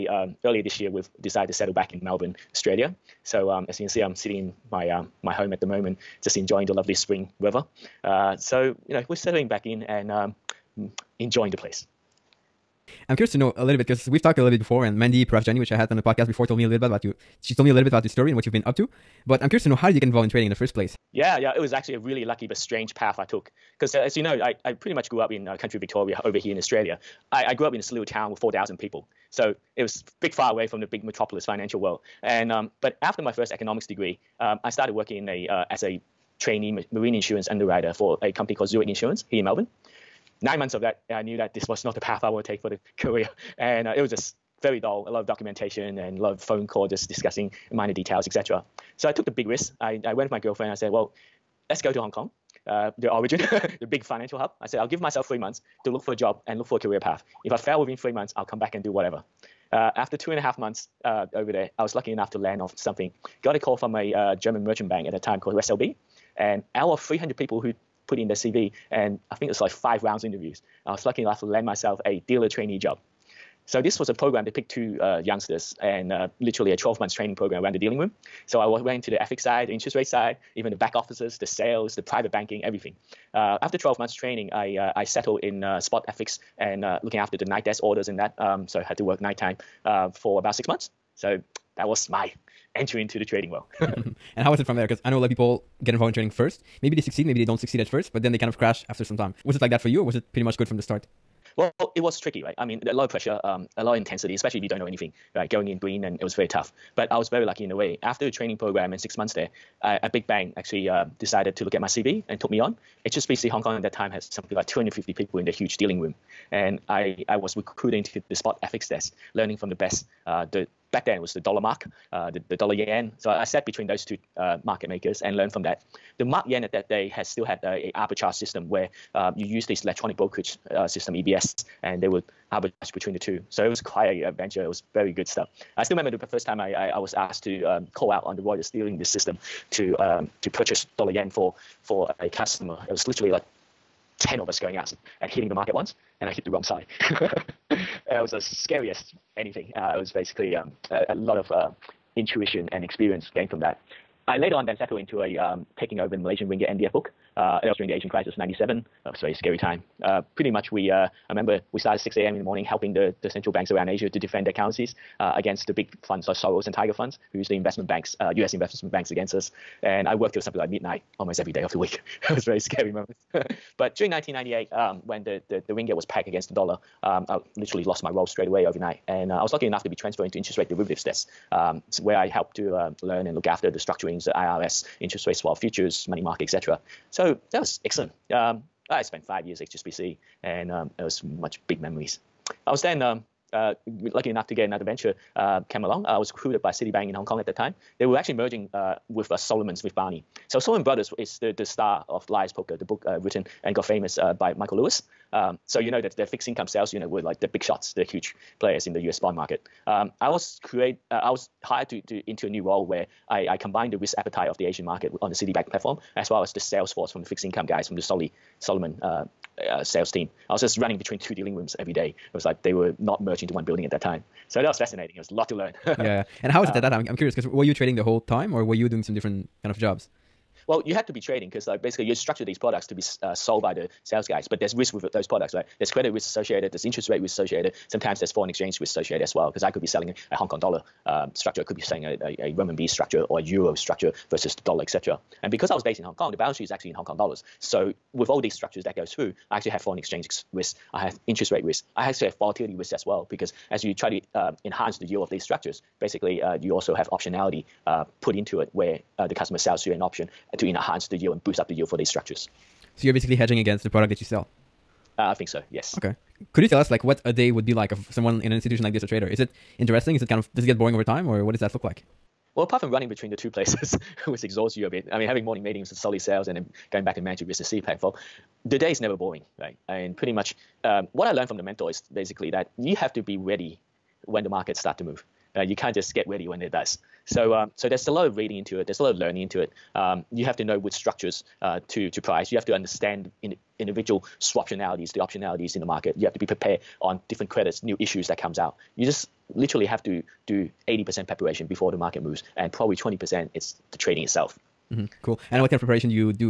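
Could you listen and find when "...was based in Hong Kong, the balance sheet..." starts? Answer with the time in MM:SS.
04:05.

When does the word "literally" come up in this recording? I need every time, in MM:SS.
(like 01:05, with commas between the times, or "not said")
01:16, 02:23, 02:57, 04:59.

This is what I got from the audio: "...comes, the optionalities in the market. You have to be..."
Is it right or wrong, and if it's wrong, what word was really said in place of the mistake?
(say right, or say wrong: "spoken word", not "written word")
wrong: "swaptionalities", not "comes".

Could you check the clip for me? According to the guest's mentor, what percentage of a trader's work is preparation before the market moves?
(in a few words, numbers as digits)
80%.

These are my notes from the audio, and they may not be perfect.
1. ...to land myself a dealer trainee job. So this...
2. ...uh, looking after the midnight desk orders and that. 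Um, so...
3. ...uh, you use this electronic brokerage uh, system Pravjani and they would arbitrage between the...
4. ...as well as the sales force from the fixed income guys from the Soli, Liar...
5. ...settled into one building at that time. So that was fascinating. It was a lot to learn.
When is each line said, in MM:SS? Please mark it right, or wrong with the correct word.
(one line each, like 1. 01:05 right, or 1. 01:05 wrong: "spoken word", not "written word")
1. 01:11 right
2. 01:26 wrong: "night", not "midnight"
3. 02:09 wrong: "EBS", not "Pravjani"
4. 03:36 wrong: "Salomon", not "Liar"
5. 03:43 wrong: "merged", not "settled".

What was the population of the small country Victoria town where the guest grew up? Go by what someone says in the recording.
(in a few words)
4,000.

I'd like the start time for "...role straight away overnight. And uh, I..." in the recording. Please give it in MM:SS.
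02:58.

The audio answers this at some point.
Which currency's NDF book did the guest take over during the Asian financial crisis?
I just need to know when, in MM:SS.
02:36.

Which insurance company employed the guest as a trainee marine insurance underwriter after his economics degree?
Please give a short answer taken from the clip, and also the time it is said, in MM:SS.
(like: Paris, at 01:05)
Zurich Insurance, at 00:38.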